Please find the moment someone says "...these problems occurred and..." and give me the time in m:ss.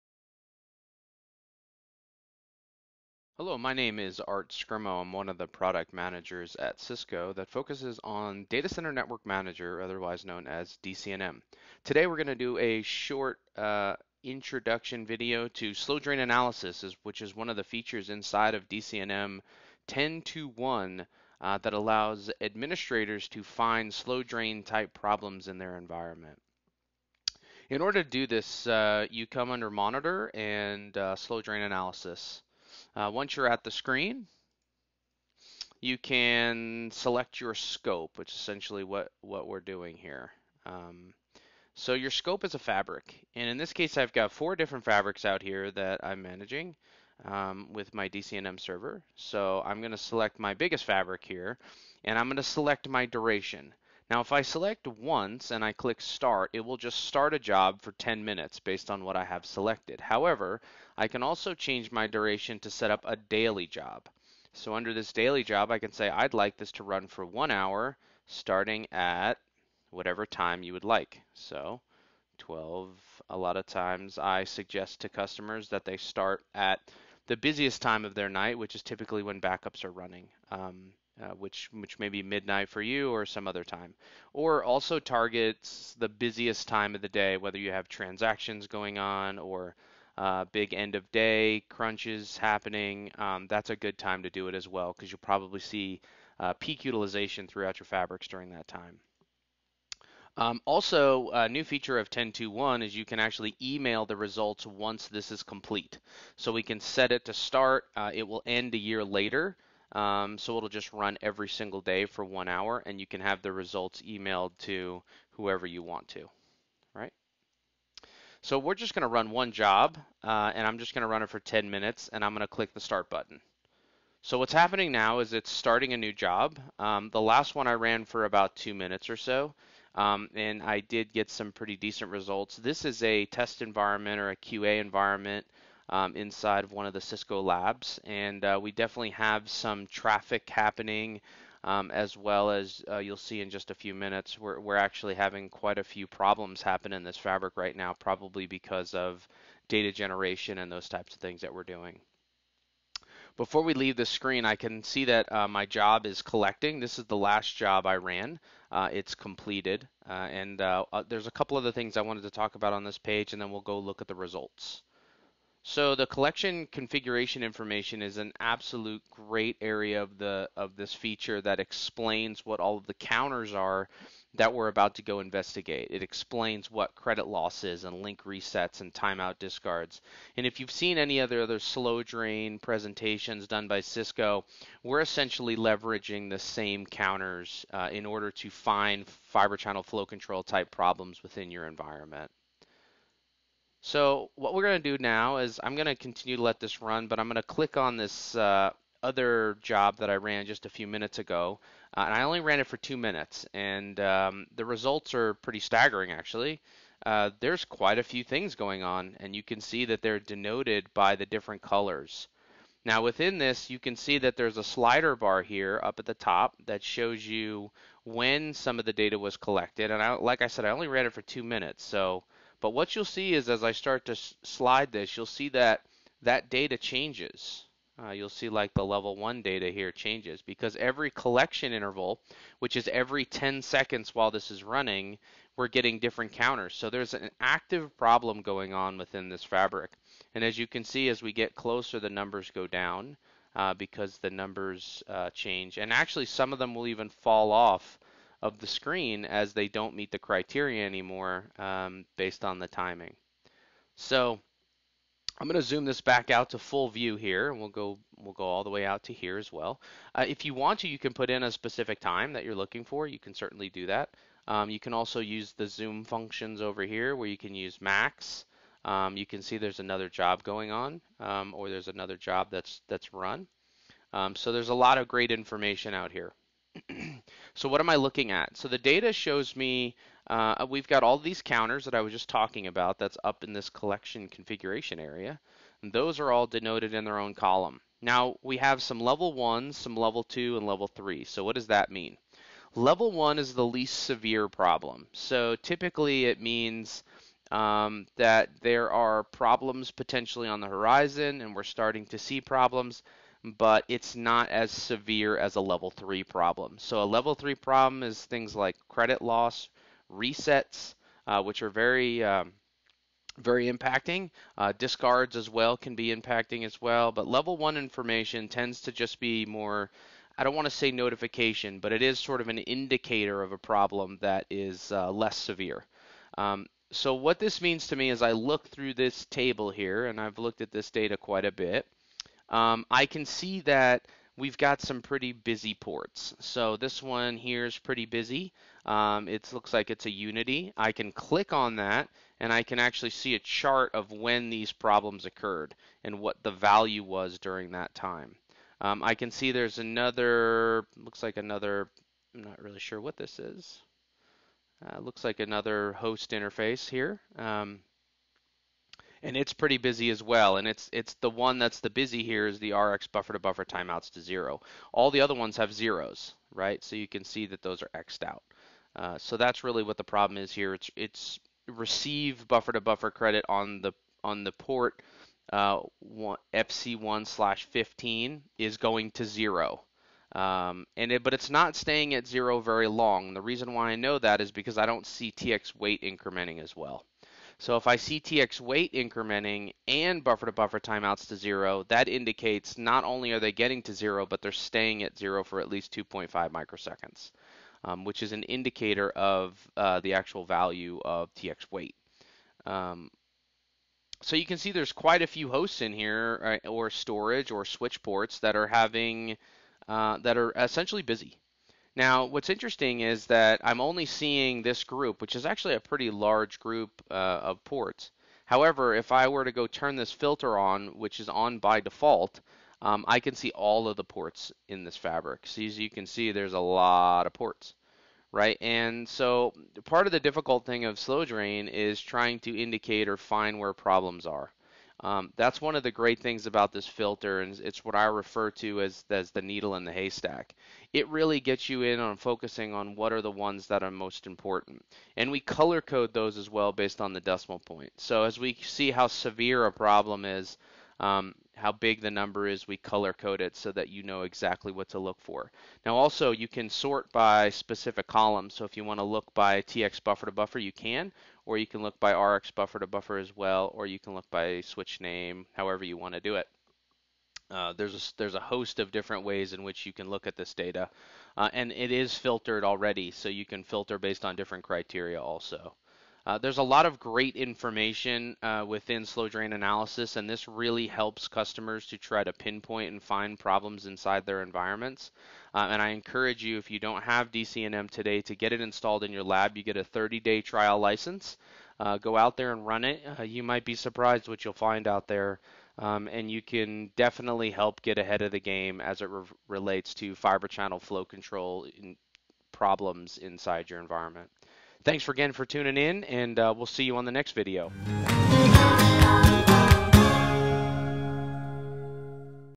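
5:44.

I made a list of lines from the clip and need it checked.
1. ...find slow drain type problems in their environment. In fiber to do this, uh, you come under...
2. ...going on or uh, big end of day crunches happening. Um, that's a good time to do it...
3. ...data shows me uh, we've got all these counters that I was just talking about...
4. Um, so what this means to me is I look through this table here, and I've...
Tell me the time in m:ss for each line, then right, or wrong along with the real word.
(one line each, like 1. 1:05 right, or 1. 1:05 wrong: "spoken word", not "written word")
1. 0:23 wrong: "order", not "fiber"
2. 1:28 right
3. 4:38 right
4. 5:26 right.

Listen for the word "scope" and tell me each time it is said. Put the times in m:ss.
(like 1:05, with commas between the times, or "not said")
0:37, 0:42.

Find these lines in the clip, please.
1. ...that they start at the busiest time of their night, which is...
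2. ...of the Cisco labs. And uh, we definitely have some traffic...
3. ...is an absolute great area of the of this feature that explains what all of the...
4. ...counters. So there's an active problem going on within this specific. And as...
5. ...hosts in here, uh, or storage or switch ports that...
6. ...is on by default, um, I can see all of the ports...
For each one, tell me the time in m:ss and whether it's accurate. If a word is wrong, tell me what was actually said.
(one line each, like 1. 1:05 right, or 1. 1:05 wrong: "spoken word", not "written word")
1. 1:15 right
2. 2:16 right
3. 2:48 right
4. 3:56 wrong: "fabric", not "specific"
5. 6:45 right
6. 7:01 right.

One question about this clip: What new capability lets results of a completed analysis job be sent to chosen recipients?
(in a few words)
Email the results.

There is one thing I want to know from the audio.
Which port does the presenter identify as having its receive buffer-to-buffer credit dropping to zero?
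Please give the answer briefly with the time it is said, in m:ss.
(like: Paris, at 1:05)
FC1/15, at 6:16.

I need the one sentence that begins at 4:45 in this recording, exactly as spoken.
And those are all denoted in their own column.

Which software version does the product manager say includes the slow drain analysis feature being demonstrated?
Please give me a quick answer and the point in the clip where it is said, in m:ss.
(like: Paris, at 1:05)
10.2.1, at 0:18.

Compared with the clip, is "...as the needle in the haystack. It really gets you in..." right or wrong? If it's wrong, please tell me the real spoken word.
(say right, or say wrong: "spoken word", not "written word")
right.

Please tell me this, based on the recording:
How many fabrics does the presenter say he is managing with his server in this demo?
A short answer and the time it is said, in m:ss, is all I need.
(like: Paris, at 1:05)
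4, at 0:44.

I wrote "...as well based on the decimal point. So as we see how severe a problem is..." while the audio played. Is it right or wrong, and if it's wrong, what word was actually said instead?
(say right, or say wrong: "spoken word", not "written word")
right.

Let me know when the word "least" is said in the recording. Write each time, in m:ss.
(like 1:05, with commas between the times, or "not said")
4:53, 6:35.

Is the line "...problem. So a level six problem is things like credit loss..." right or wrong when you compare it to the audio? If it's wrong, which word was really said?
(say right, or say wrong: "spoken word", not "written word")
wrong: "three", not "six".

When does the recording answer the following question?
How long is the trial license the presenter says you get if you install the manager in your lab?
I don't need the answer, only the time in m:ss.
8:09.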